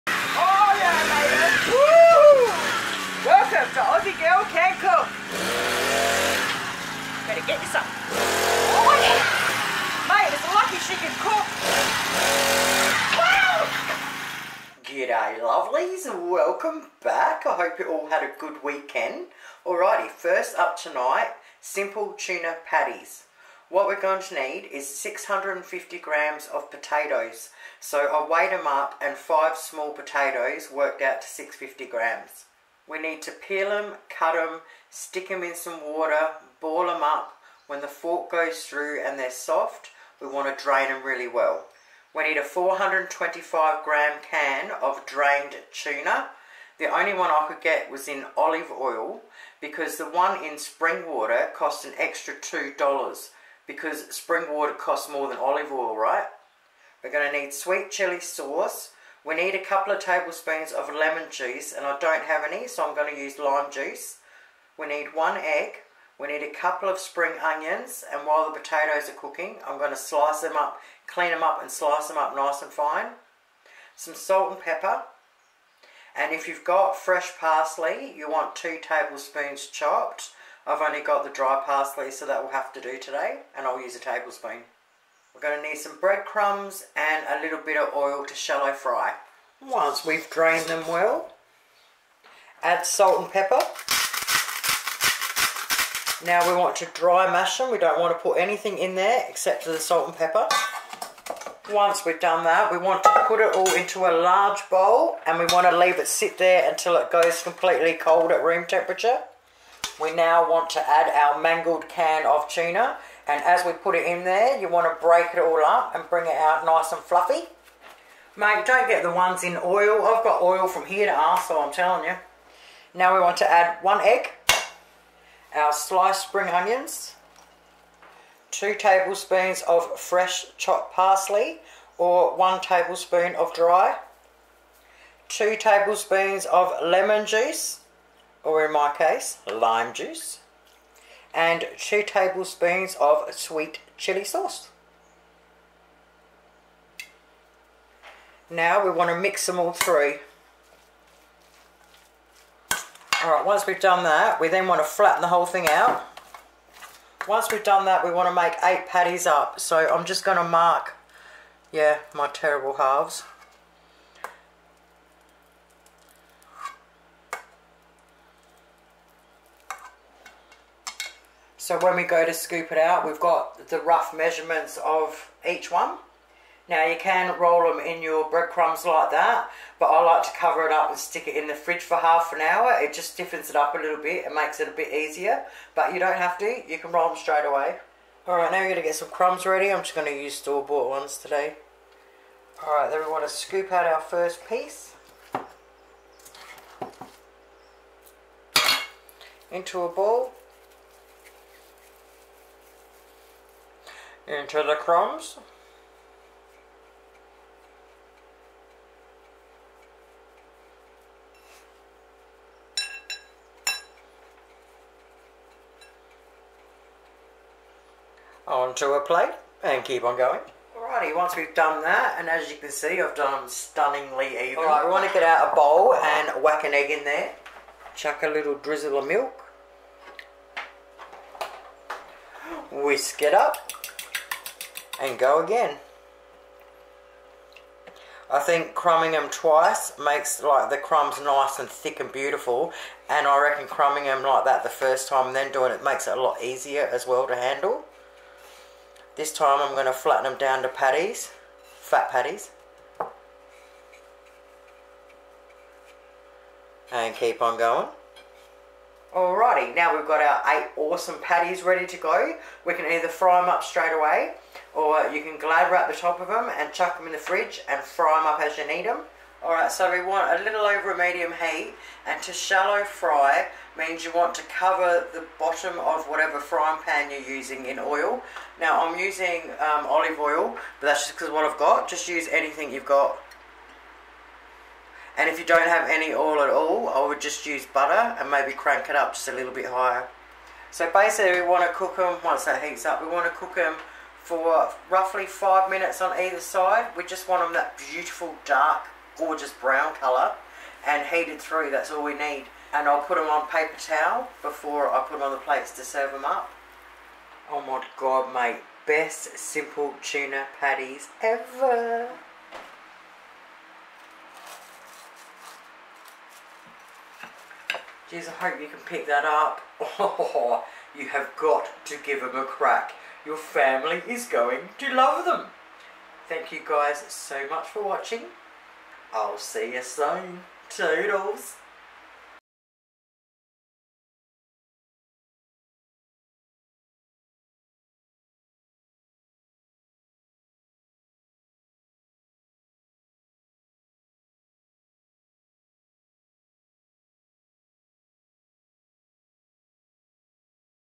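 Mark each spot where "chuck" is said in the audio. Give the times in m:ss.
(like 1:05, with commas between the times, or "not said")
3:47, 4:26.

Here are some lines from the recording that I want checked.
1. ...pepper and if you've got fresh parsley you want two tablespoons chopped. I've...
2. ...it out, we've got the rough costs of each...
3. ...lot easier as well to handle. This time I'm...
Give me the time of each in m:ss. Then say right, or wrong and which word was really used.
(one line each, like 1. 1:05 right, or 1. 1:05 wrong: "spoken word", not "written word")
1. 1:14 right
2. 2:52 wrong: "measurements", not "costs"
3. 4:06 right.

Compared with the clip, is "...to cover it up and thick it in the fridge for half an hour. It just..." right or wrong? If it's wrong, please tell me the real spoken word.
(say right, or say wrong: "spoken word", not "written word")
wrong: "stick", not "thick".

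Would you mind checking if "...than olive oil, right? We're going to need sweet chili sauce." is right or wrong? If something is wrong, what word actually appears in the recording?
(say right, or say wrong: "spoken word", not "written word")
right.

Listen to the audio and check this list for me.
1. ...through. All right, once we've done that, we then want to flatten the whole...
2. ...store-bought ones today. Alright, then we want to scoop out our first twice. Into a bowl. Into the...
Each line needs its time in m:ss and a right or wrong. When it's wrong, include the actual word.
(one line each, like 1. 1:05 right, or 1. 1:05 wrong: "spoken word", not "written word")
1. 2:29 right
2. 3:10 wrong: "piece", not "twice".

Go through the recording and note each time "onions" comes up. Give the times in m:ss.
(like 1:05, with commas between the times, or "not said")
1:07, 2:06.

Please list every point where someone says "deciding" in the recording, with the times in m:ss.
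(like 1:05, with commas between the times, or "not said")
not said.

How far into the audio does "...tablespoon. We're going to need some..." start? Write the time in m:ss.
1:23.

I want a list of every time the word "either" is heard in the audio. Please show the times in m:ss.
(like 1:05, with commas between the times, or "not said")
4:22, 4:56.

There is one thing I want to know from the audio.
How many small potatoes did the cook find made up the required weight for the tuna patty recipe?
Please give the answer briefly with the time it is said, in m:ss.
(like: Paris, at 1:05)
5, at 0:29.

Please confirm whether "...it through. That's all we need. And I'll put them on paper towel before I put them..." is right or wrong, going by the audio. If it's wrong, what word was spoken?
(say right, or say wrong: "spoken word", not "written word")
right.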